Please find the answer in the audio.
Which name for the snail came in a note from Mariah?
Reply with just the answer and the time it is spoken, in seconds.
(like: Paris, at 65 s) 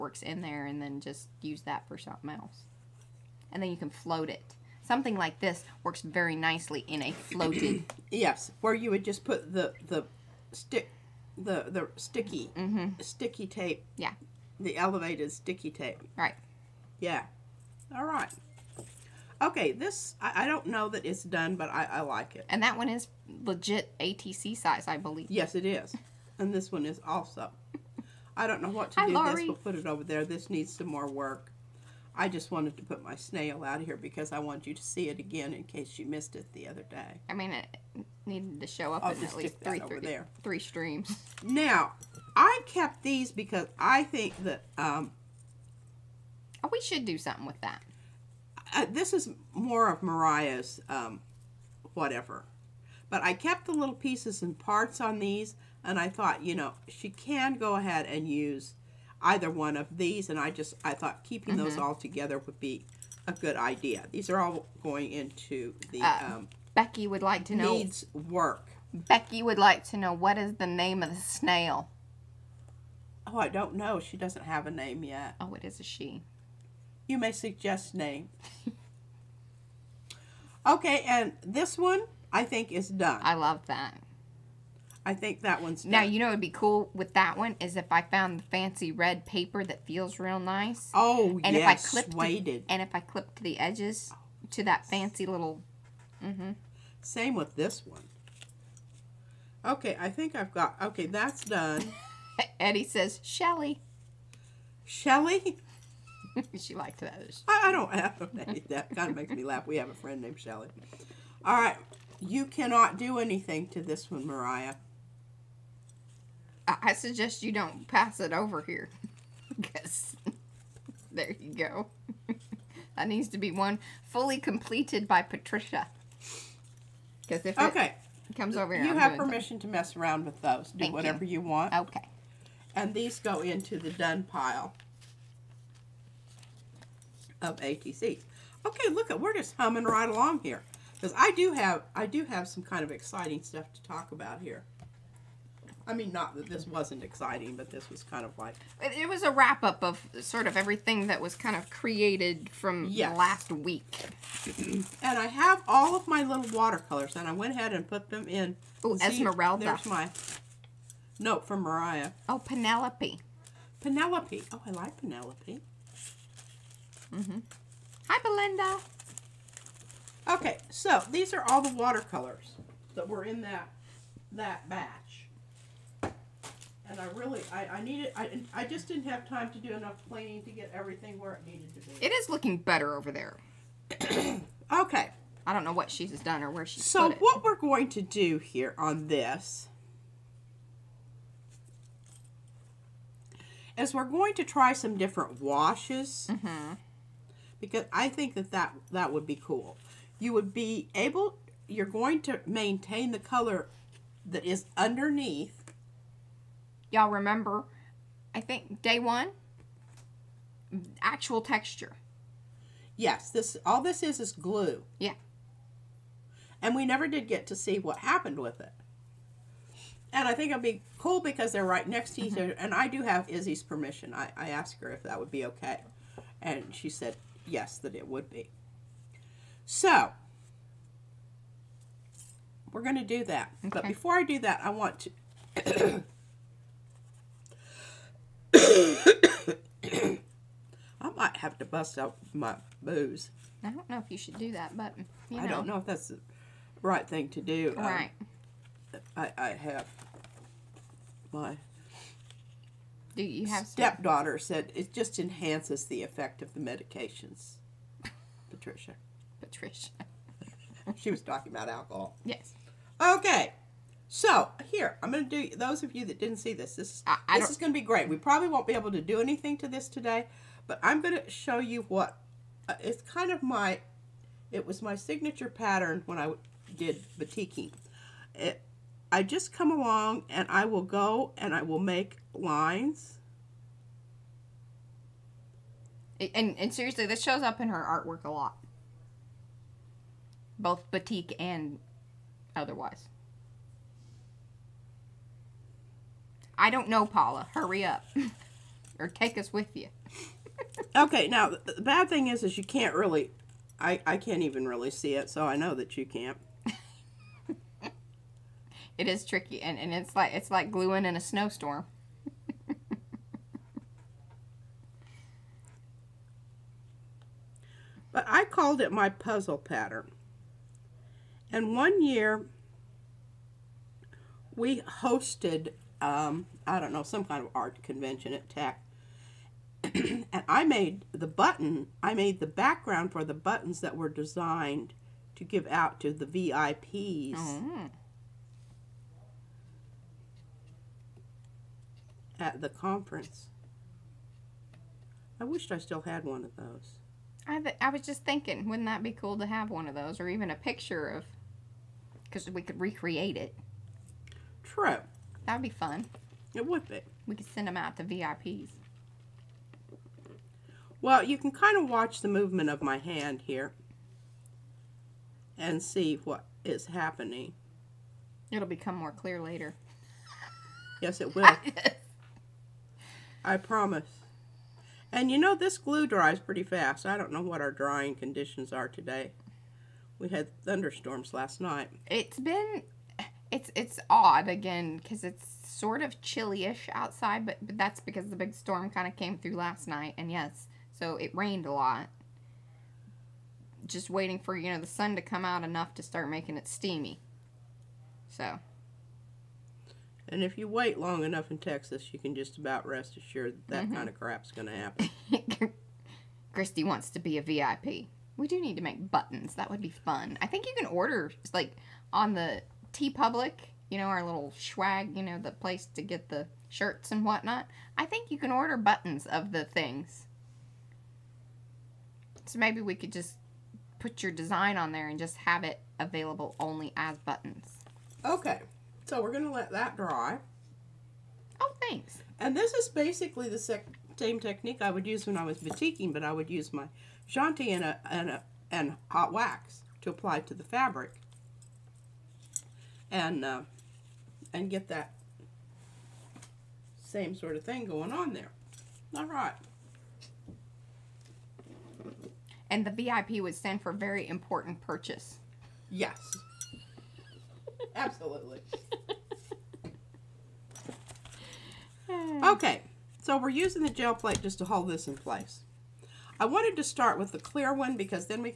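Esmeralda, at 159 s.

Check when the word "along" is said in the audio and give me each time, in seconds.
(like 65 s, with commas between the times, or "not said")
140 s, 279 s.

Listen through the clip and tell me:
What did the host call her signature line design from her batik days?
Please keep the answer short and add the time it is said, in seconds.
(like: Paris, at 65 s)
puzzle pattern, at 319 s.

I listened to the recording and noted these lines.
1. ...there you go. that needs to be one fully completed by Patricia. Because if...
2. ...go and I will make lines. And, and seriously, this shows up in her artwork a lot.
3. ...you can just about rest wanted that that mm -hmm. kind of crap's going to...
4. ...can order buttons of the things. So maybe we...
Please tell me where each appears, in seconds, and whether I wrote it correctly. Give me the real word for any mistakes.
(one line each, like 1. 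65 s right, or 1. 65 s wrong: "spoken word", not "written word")
1. 121 s right
2. 280 s right
3. 402 s wrong: "assured", not "wanted"
4. 418 s right.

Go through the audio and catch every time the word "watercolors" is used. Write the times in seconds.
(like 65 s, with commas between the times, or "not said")
156 s, 171 s.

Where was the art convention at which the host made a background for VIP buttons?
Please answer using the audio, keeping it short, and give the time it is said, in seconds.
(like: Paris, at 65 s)
Tech, at 328 s.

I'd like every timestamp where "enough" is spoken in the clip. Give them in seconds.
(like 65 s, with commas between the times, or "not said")
179 s, 395 s, 401 s.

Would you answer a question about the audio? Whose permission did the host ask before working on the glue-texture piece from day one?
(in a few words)
Izzy.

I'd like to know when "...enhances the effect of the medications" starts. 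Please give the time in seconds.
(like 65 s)
255 s.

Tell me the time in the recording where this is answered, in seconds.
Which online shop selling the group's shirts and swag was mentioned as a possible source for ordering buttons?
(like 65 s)
412 s.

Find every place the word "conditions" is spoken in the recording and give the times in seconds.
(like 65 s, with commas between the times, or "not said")
378 s.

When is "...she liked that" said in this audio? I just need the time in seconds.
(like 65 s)
106 s.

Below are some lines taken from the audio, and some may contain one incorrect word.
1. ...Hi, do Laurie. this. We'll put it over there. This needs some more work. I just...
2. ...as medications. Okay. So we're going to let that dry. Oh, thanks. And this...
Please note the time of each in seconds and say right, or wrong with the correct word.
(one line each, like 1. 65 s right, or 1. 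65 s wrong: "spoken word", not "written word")
1. 28 s right
2. 426 s wrong: "buttons", not "medications".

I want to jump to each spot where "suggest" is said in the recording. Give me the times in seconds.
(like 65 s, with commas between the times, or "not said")
77 s, 116 s.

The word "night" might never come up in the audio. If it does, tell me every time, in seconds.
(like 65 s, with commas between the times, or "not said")
381 s, 389 s.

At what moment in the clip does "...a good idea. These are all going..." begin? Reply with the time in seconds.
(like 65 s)
63 s.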